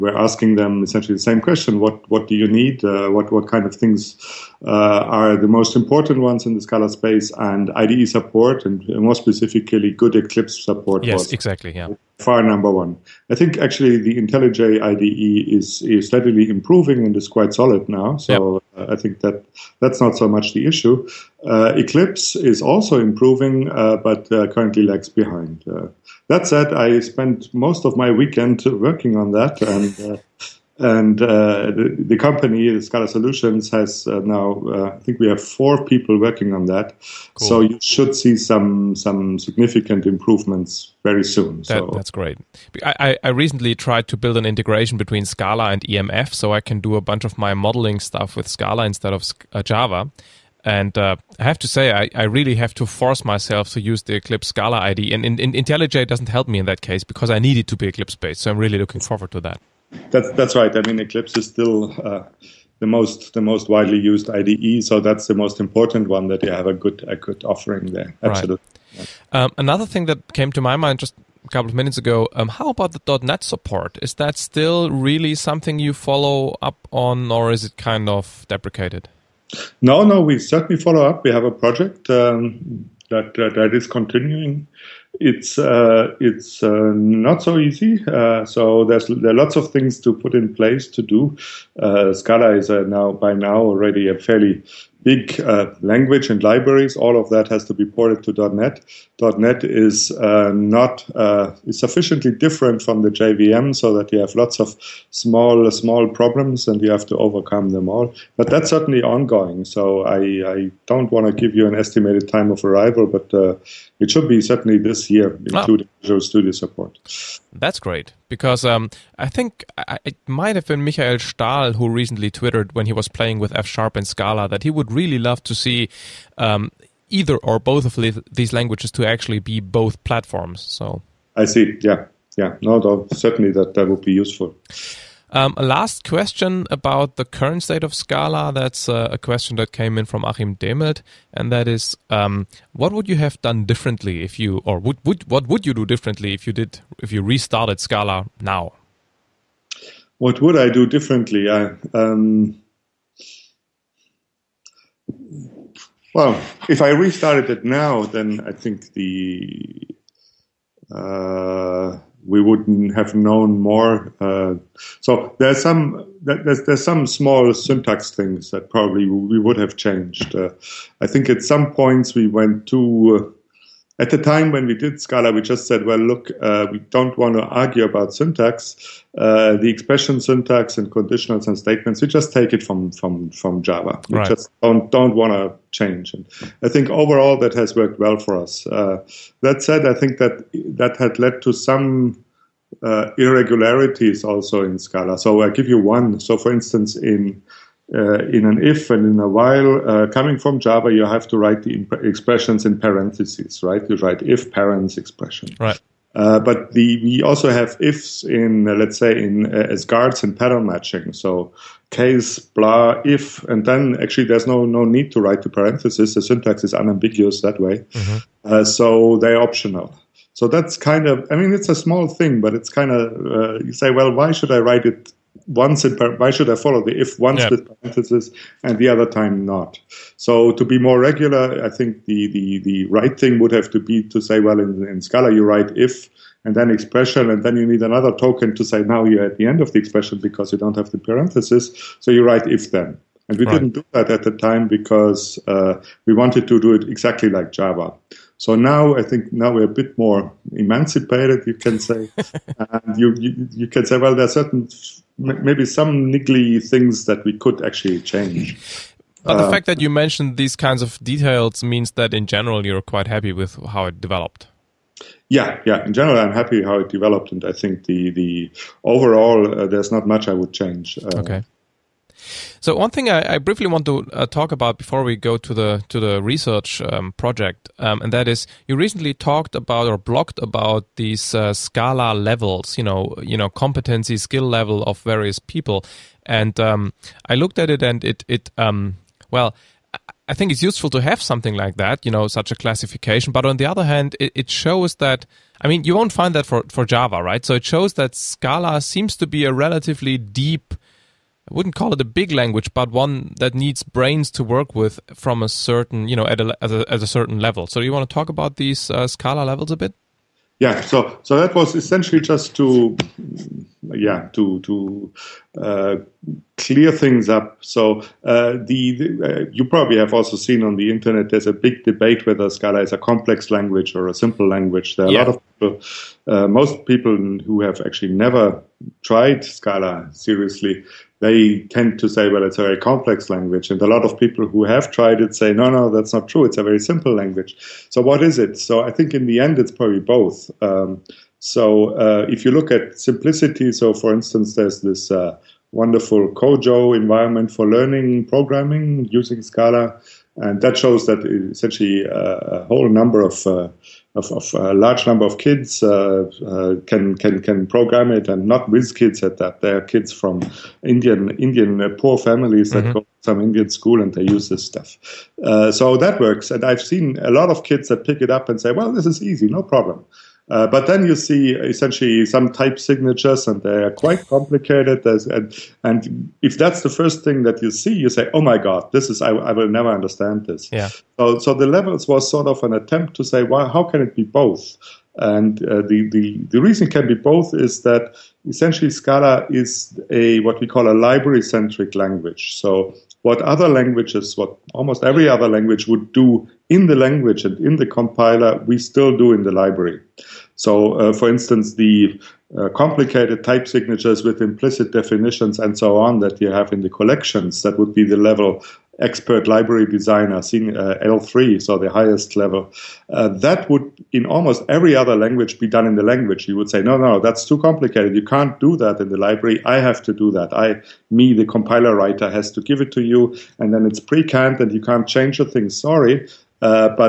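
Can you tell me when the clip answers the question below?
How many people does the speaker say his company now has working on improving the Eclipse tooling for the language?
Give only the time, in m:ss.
0:35.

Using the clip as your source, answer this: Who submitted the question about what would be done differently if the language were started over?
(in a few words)
Achim Demelt.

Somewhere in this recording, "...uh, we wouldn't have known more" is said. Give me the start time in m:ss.
2:40.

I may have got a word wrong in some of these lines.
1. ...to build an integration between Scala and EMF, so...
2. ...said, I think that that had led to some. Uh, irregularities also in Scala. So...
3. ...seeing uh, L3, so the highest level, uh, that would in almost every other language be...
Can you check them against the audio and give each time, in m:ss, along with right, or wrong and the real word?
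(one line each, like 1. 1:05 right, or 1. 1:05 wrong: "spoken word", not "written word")
1. 0:44 right
2. 3:09 right
3. 6:50 right.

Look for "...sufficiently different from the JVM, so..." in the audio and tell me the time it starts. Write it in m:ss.
1:41.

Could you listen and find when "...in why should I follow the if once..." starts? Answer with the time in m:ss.
3:45.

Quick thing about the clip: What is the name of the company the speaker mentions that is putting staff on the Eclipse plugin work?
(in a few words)
Scala Solutions.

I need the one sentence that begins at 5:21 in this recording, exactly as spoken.
There's a big debate whether Scala is a complex language or a simple language.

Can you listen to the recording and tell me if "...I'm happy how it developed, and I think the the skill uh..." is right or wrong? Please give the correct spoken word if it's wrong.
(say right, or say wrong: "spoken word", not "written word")
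wrong: "overall", not "skill".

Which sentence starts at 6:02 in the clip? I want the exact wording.
go to some Indian school and they use this stuff.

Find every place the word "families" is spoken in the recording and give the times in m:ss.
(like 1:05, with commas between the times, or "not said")
6:02.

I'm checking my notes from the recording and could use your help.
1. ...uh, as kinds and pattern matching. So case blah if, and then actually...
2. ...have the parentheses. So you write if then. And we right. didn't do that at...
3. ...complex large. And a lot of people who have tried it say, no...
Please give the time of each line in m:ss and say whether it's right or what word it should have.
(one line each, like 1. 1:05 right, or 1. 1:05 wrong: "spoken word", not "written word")
1. 3:29 wrong: "guards", not "kinds"
2. 4:00 right
3. 5:32 wrong: "language", not "large".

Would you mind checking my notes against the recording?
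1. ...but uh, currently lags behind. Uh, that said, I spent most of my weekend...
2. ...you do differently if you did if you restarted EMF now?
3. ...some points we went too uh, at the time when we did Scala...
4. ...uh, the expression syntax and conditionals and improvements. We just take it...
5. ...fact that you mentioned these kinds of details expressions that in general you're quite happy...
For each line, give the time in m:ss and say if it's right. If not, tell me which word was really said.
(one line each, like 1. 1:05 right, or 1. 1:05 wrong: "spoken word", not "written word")
1. 0:23 right
2. 2:25 wrong: "Scala", not "EMF"
3. 2:51 right
4. 2:59 wrong: "statements", not "improvements"
5. 4:19 wrong: "means", not "expressions".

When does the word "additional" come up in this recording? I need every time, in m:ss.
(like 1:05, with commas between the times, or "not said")
not said.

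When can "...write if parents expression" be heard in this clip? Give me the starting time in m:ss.
3:23.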